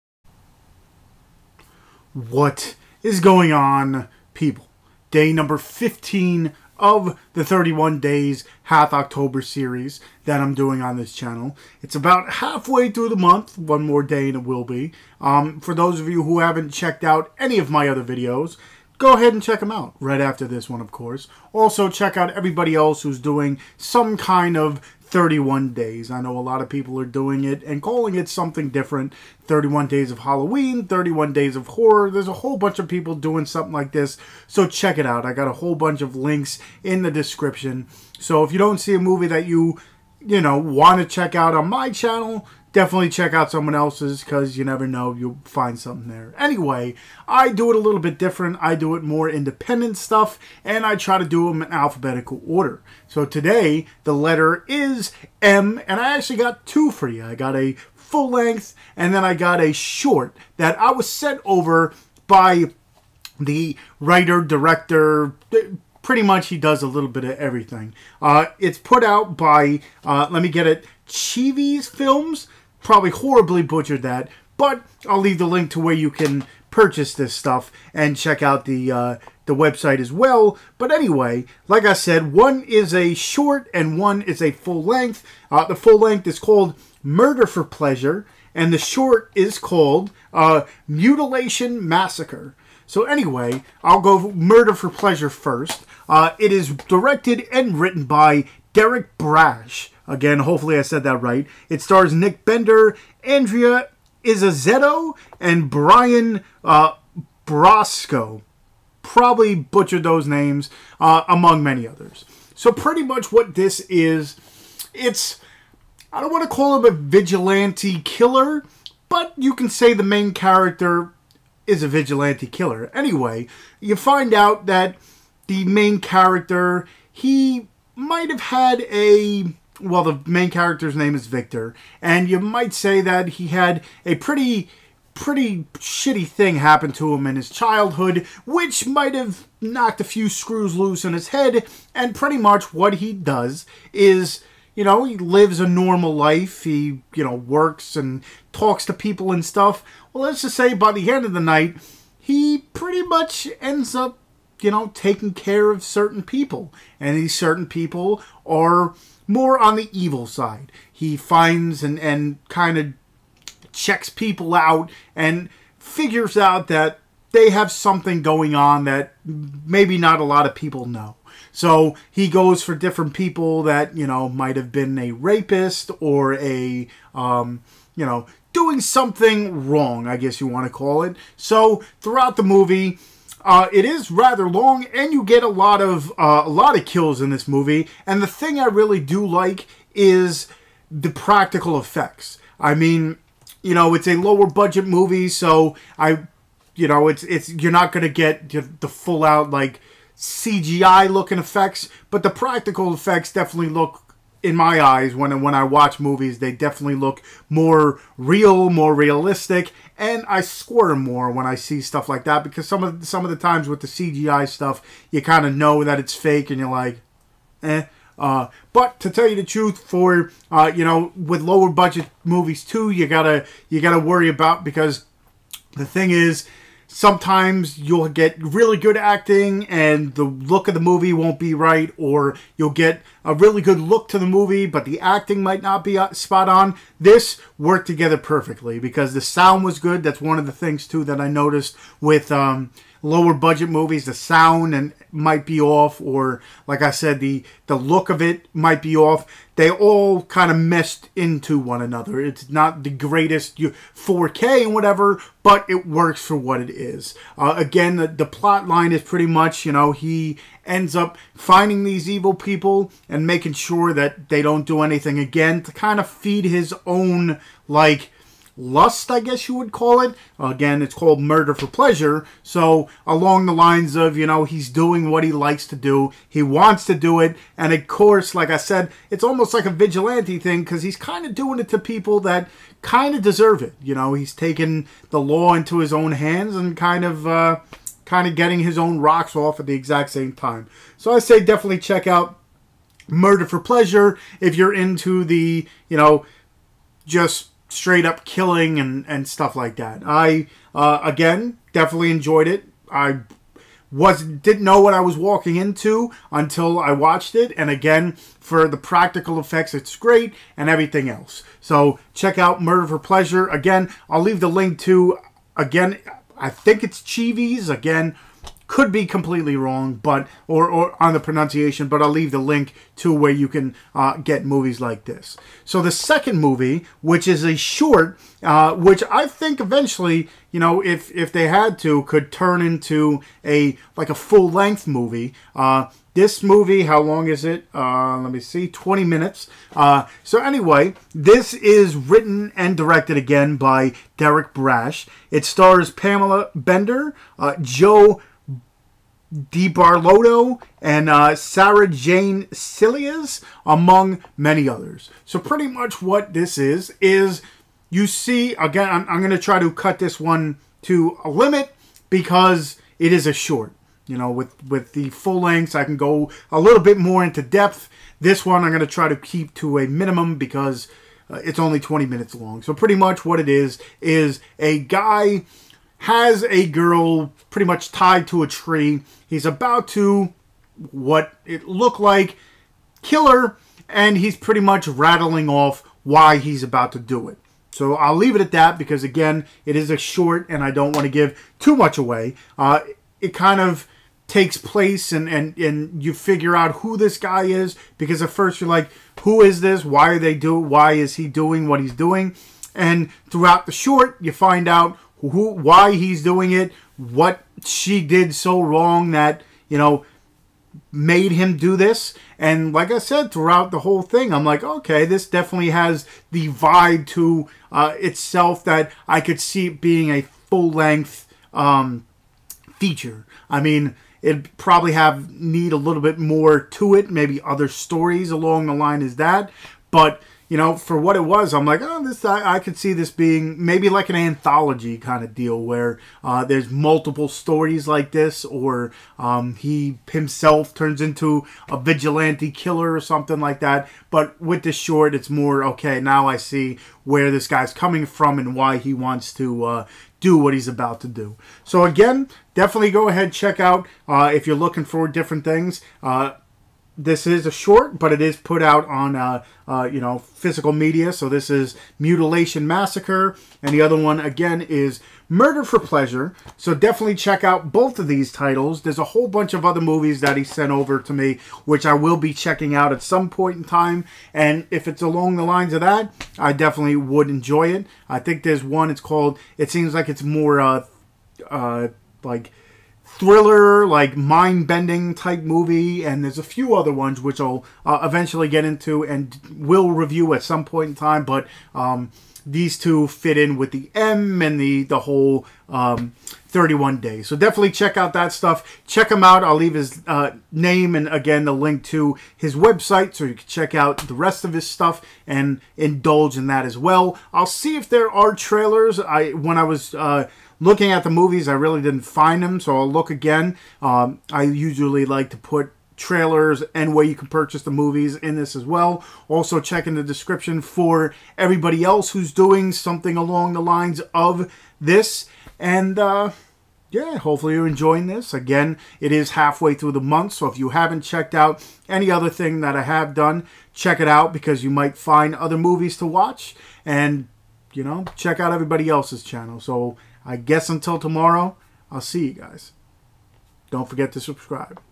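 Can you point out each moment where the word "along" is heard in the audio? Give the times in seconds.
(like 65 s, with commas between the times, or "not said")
273 s, 428 s, 475 s, 523 s.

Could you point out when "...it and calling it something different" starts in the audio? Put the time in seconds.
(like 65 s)
27 s.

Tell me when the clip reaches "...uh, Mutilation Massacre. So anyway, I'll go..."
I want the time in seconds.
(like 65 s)
90 s.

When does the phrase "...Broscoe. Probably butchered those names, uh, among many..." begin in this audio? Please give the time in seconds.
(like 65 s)
107 s.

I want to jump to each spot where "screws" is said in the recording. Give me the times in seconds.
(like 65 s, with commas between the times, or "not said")
140 s.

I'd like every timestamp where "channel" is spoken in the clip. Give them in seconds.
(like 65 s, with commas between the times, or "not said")
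11 s, 41 s, 539 s.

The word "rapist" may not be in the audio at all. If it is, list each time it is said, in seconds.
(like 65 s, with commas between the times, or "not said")
175 s.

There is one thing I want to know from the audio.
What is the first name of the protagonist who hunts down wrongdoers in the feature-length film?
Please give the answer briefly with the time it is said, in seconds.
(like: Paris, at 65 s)
Victor, at 131 s.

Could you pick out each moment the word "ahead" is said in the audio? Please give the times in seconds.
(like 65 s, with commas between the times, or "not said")
19 s, 453 s.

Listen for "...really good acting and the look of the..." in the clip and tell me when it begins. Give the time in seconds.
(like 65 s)
228 s.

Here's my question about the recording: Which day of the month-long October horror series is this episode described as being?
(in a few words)
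15.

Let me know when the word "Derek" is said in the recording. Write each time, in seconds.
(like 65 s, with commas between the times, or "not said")
98 s, 344 s.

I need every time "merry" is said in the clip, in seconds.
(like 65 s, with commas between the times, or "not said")
not said.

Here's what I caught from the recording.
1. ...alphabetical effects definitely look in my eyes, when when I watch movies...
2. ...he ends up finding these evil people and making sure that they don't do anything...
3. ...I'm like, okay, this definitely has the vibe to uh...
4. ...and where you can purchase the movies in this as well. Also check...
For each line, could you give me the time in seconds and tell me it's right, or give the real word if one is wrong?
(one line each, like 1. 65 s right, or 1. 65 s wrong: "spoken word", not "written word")
1. 202 s wrong: "practical", not "alphabetical"
2. 259 s right
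3. 414 s right
4. 516 s right.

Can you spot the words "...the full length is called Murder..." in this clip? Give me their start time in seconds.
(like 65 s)
85 s.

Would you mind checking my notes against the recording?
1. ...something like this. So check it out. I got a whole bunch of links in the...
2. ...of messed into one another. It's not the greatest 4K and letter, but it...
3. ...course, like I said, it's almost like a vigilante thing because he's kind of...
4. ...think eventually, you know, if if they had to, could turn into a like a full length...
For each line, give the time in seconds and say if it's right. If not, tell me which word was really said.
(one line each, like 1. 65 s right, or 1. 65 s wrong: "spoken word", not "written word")
1. 33 s right
2. 250 s wrong: "whatever", not "letter"
3. 277 s right
4. 329 s right.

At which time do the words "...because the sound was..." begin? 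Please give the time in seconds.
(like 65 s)
238 s.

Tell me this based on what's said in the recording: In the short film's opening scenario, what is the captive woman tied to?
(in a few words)
a tree.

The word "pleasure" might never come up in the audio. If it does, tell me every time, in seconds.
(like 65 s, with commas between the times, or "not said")
87 s, 94 s, 271 s, 293 s, 312 s, 465 s.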